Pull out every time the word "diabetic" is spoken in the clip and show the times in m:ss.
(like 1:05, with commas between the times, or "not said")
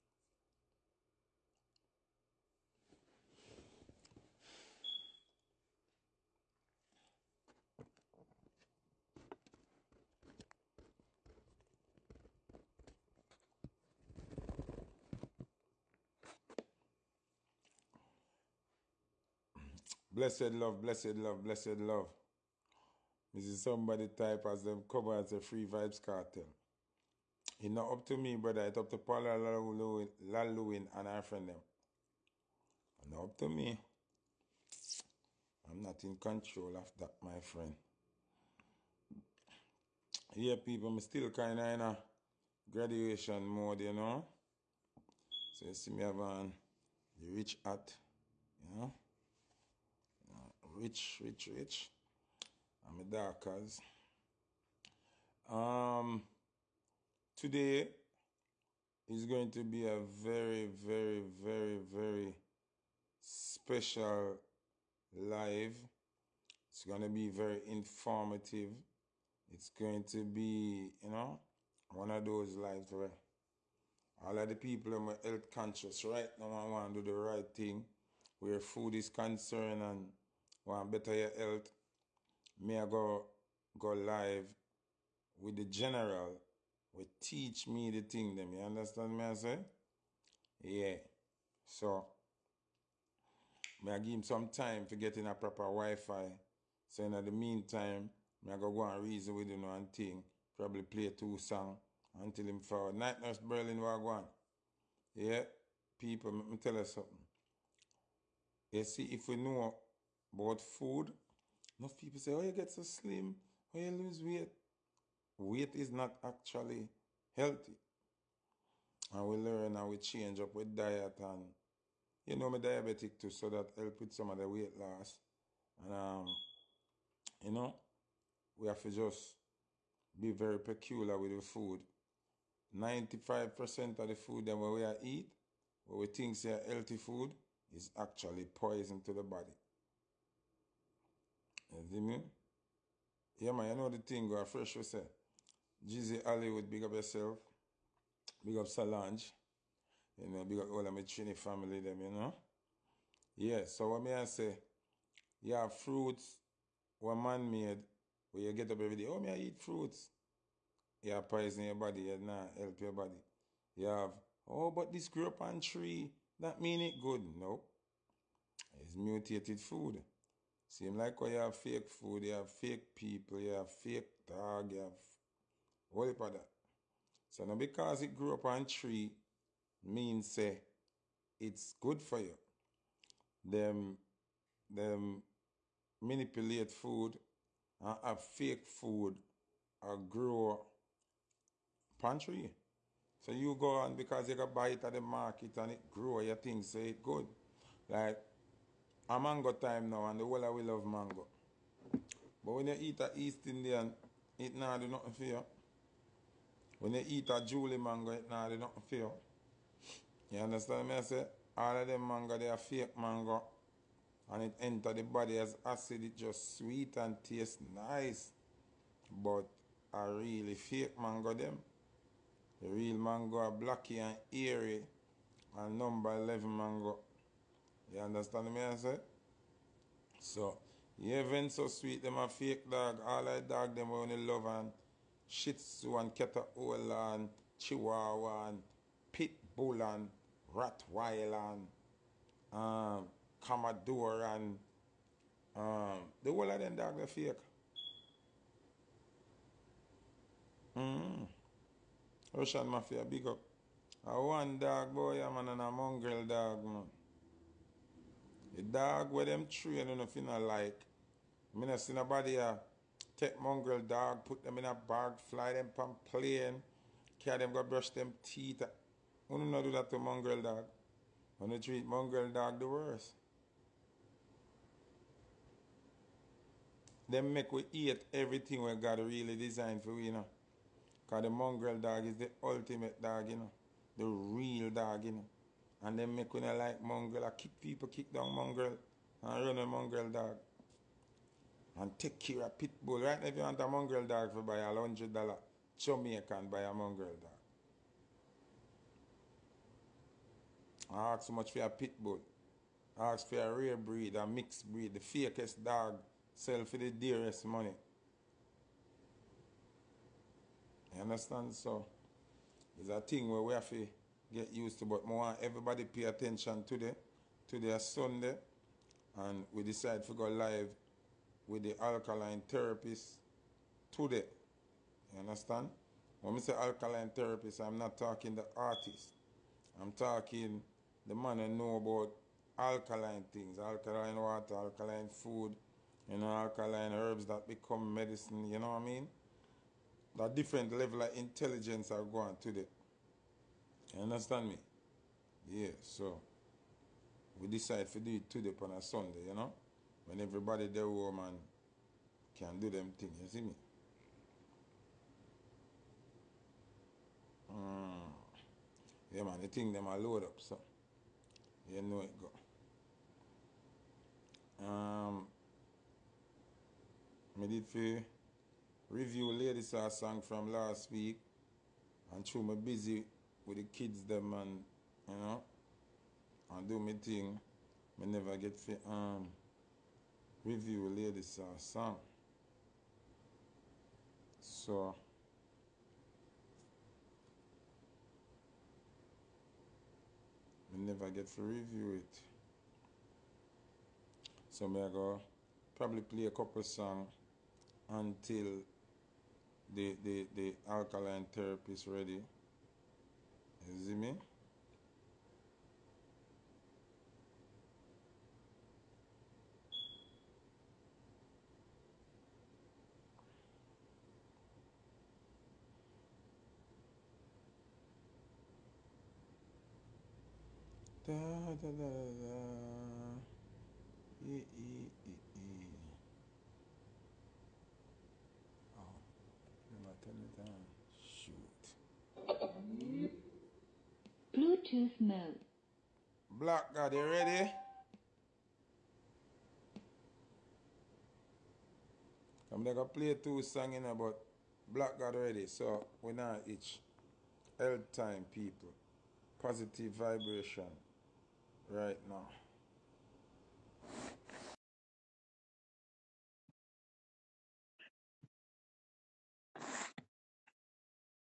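2:02.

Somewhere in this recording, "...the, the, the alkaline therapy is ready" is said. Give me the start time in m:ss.
6:39.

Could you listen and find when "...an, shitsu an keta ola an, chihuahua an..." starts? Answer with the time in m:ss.
3:54.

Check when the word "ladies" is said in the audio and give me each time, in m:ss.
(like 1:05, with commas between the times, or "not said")
6:09, 6:20.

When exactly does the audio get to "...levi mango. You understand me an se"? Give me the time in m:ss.
3:46.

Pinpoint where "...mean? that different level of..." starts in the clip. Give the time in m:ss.
5:38.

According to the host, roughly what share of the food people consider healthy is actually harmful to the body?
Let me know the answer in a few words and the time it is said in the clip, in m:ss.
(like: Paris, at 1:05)
95%, at 2:12.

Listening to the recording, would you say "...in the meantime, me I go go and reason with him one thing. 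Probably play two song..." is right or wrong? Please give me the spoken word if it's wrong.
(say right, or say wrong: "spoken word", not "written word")
right.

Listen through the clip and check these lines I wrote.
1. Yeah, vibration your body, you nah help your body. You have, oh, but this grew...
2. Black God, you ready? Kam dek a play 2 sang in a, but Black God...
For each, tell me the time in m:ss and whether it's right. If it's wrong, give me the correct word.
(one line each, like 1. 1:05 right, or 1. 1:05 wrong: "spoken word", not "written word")
1. 2:41 wrong: "poison", not "vibration"
2. 7:16 right.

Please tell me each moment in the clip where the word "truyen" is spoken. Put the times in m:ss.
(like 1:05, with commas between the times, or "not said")
4:19, 4:31.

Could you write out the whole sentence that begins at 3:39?
But a really fake mango dem.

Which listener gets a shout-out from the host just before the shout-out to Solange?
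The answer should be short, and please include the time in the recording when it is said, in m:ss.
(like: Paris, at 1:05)
Jeezy Hollywood, at 2:25.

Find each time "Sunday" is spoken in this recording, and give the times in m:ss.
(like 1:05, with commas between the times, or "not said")
5:17, 5:48.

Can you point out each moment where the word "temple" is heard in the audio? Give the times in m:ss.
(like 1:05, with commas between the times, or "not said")
not said.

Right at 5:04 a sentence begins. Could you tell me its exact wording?
The fakest dog sell fwe de dearest money.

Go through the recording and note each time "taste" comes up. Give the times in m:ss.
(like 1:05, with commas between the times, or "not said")
3:37.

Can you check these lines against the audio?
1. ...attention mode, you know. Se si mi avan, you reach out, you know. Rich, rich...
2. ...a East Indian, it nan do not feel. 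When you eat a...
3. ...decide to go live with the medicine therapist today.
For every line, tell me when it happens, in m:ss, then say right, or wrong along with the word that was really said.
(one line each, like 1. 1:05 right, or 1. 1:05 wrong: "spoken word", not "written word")
1. 0:42 wrong: "graduation", not "attention"
2. 3:22 right
3. 5:19 wrong: "alkaline", not "medicine".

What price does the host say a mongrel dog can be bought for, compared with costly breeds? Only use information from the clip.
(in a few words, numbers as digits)
$100.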